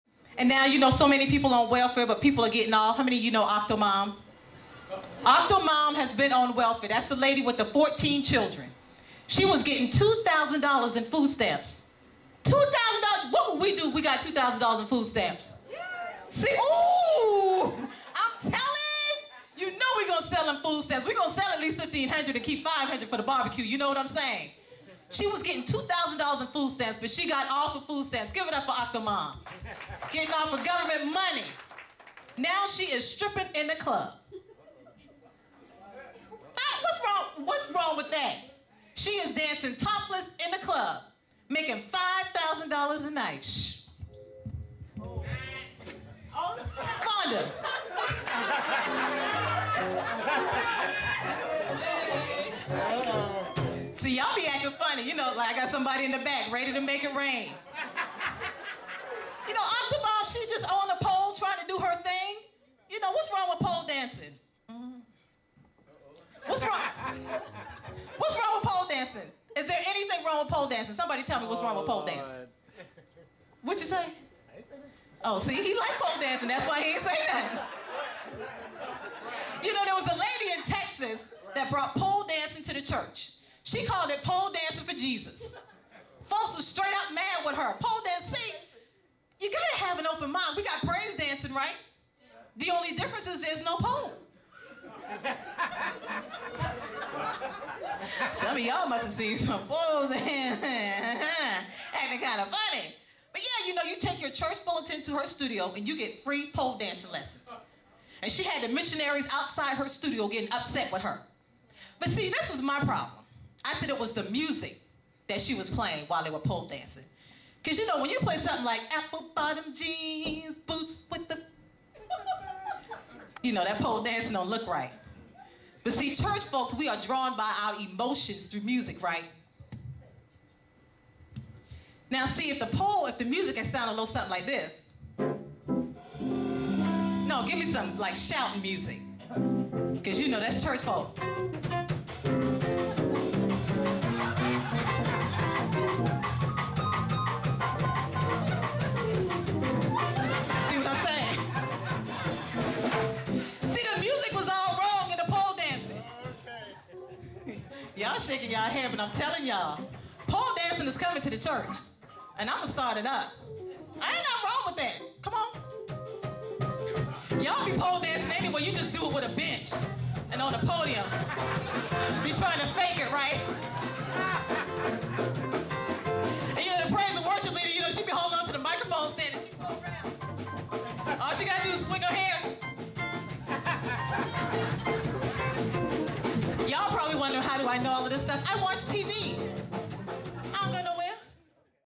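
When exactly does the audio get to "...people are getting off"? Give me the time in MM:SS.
00:02.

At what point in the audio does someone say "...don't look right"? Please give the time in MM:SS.
02:04.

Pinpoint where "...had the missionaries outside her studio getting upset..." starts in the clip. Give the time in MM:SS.
01:48.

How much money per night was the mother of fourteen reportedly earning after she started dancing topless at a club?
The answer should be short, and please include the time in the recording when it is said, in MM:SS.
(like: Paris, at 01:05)
$5,000, at 00:41.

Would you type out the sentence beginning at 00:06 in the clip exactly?
That's the lady with the 14 children.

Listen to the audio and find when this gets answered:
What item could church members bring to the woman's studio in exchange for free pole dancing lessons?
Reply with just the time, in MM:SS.
01:44.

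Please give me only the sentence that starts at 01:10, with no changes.
Somebody tell me what's wrong with pole oh, dancing.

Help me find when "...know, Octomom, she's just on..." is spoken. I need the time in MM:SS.
00:59.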